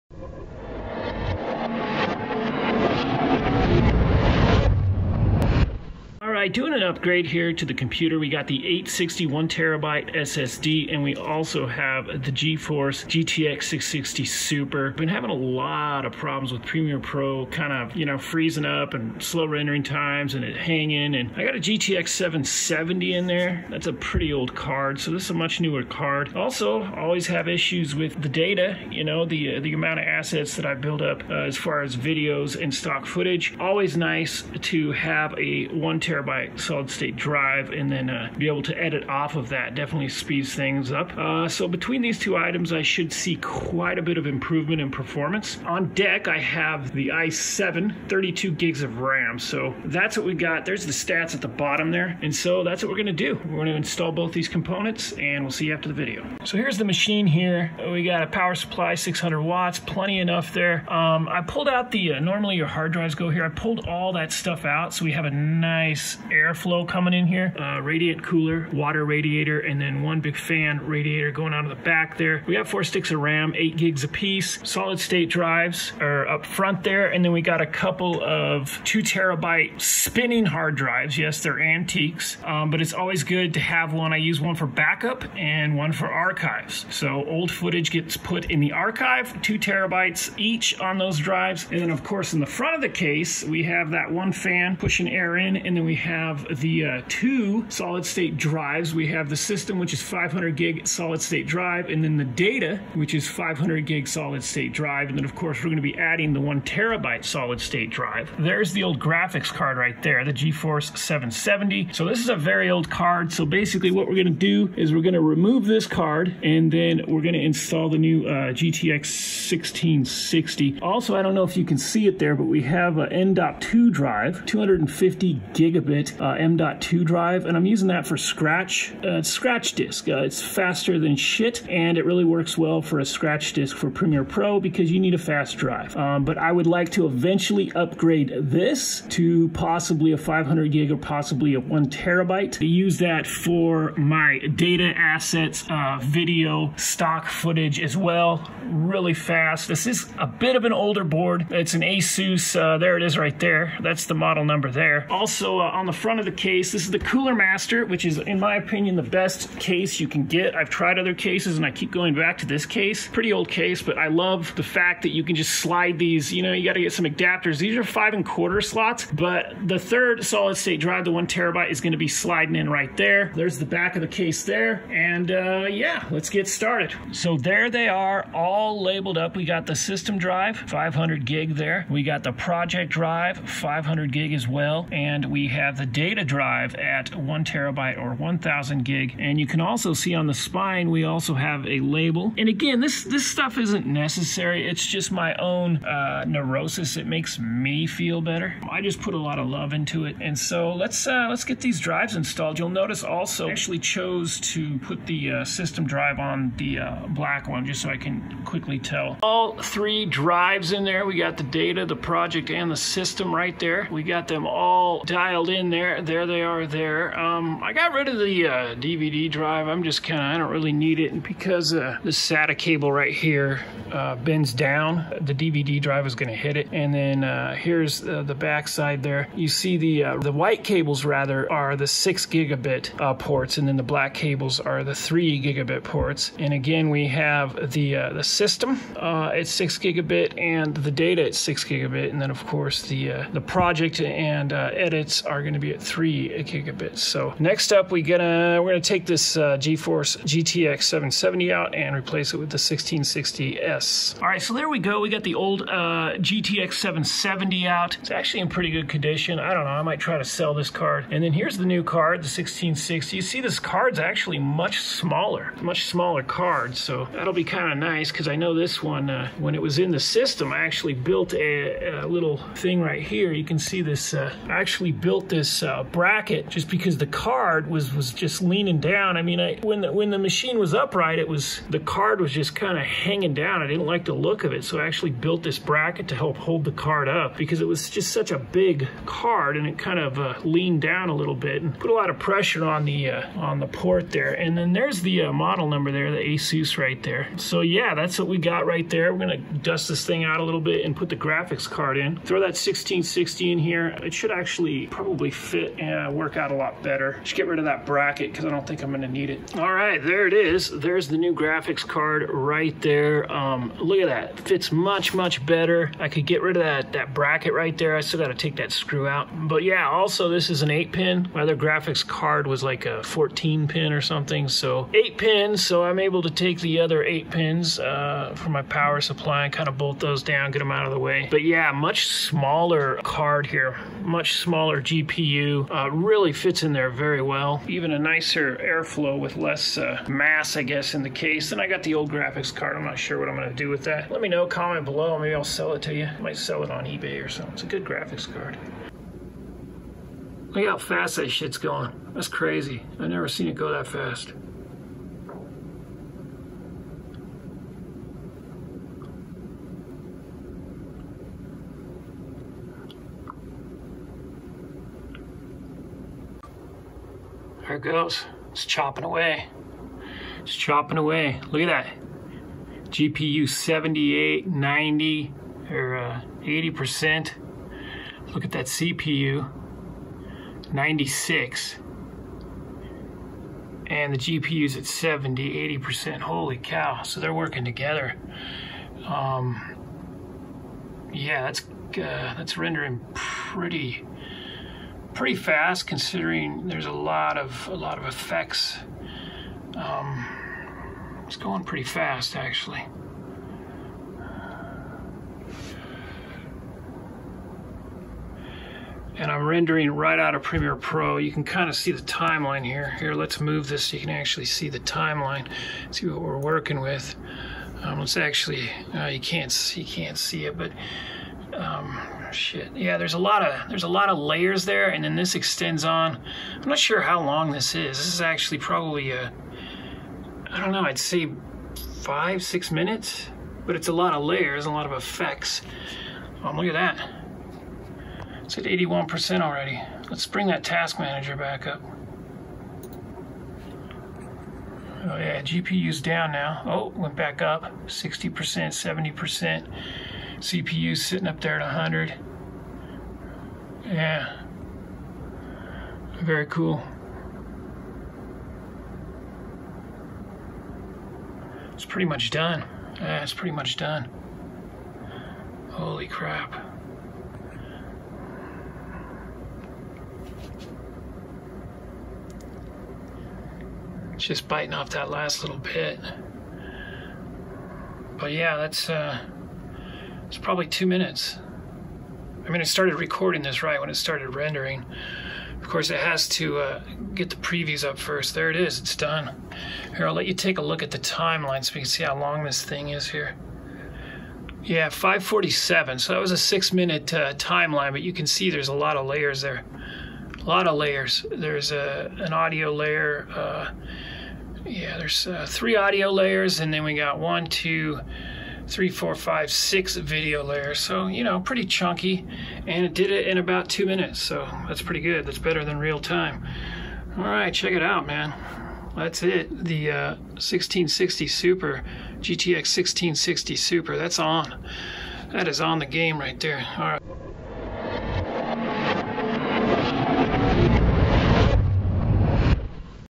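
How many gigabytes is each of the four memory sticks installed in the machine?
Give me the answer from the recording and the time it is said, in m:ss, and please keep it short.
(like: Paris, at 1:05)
8 gigs, at 1:13.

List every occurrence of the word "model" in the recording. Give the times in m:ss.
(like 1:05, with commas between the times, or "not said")
2:34, 4:55.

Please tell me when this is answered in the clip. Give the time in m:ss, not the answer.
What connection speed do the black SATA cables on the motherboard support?
3:54.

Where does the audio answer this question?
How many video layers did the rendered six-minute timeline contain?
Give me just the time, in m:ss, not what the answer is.
8:29.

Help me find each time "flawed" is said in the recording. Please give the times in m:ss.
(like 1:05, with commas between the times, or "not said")
not said.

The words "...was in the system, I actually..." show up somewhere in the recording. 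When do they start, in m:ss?
4:29.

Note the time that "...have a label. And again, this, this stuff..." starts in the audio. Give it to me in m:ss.
3:11.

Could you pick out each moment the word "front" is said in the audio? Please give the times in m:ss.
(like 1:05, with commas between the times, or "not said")
1:16, 1:32, 2:35.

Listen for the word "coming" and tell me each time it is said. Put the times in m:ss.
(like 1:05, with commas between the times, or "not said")
1:06.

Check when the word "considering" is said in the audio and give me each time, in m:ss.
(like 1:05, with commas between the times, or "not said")
6:35.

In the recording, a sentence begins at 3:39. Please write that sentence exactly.
I'm just kind of, I don't really need it.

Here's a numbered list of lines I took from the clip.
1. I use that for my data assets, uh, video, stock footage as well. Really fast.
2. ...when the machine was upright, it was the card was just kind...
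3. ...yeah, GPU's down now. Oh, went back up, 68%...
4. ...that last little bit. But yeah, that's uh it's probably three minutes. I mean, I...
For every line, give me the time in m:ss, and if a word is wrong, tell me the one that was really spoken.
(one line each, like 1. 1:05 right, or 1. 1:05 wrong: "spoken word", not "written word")
1. 2:22 right
2. 4:39 right
3. 7:25 wrong: "60", not "68"
4. 7:54 wrong: "two", not "three".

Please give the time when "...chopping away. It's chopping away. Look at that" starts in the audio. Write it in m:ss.
6:08.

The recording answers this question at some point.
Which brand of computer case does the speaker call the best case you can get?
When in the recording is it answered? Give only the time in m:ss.
2:36.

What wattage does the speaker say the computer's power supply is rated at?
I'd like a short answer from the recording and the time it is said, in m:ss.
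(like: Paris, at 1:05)
600 watts, at 0:58.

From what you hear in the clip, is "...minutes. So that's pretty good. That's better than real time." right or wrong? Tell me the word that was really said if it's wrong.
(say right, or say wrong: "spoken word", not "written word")
right.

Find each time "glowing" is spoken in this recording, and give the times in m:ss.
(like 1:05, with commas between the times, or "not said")
not said.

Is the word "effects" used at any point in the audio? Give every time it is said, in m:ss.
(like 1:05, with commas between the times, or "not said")
6:38, 7:14.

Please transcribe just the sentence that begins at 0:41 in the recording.
Uh, so between these two items, I should see quite a bit of improvement in performance.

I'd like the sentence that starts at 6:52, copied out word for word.
Here, let's move this so you can actually see the timeline, see what we're working with.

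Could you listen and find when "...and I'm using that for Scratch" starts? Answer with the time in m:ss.
2:07.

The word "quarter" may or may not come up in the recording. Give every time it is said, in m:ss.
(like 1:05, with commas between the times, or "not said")
2:48.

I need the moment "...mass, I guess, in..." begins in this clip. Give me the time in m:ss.
5:40.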